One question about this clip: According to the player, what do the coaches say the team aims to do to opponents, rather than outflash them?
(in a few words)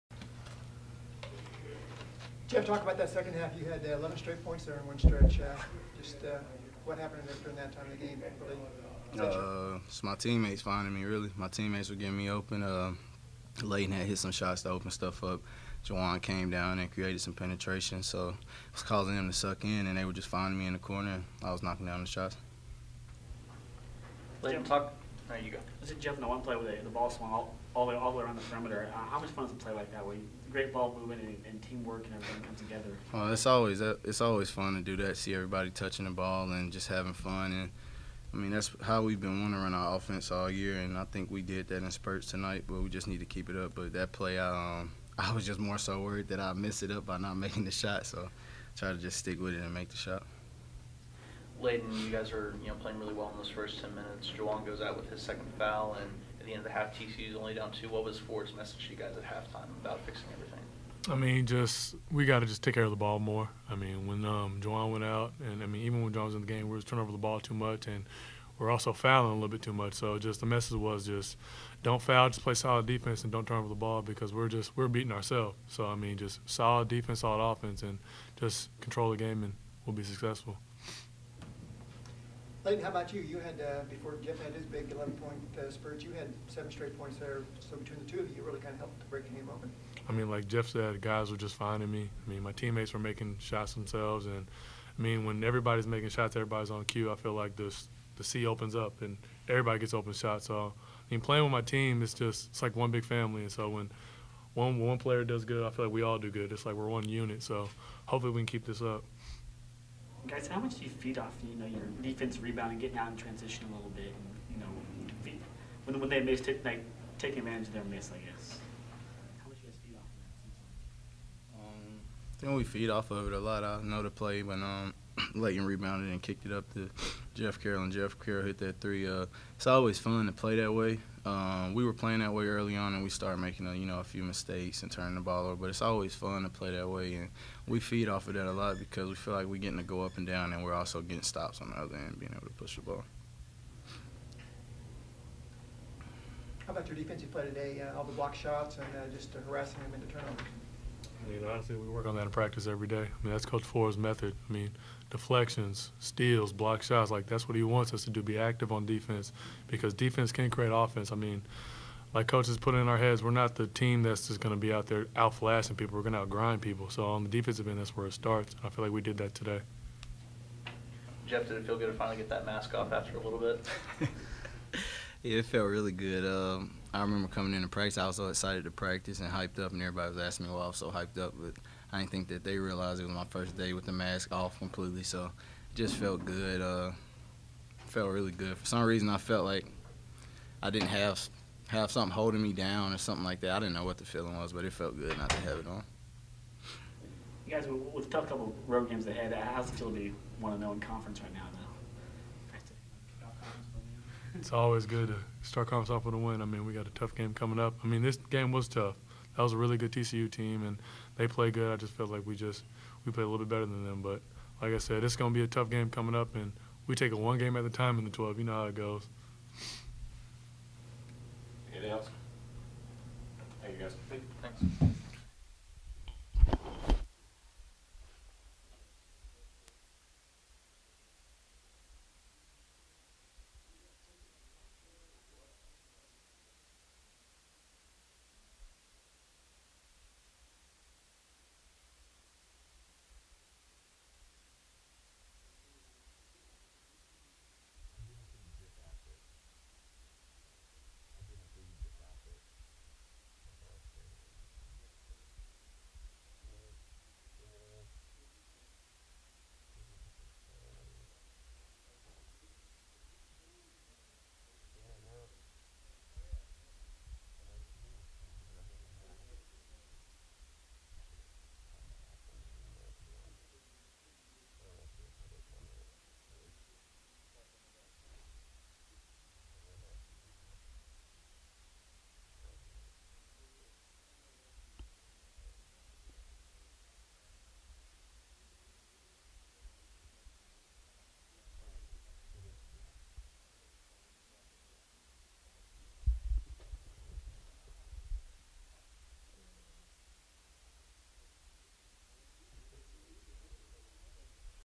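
Outgrind people.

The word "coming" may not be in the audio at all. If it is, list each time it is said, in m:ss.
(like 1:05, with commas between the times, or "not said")
2:57, 3:27, 3:35.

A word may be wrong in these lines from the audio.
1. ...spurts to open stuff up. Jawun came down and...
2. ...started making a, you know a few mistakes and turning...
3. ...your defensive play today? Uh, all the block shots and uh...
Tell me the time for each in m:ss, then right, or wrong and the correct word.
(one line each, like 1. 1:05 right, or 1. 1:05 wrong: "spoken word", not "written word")
1. 0:14 wrong: "shots", not "spurts"
2. 2:13 right
3. 2:26 right.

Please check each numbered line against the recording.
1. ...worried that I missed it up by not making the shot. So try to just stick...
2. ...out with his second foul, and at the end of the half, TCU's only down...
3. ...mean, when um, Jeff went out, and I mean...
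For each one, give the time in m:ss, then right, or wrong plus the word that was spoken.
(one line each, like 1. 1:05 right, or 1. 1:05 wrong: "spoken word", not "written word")
1. 0:46 right
2. 0:54 right
3. 1:03 wrong: "Jawun", not "Jeff".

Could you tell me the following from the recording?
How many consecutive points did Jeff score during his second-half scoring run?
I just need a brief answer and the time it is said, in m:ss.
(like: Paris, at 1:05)
11, at 0:03.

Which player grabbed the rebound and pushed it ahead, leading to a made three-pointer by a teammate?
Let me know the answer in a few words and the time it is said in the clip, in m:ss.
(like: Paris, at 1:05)
Leighton, at 2:05.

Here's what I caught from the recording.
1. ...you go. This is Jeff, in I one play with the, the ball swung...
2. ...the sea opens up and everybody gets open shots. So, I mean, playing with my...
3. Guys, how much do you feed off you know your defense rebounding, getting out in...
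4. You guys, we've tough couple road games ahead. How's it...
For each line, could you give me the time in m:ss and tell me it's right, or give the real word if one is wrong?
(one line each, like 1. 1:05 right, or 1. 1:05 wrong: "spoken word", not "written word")
1. 0:25 right
2. 1:38 right
3. 1:50 right
4. 3:17 right.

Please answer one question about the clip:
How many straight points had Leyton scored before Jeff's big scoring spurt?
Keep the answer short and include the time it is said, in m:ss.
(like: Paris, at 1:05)
7, at 1:26.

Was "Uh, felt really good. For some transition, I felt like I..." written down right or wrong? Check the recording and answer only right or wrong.
wrong.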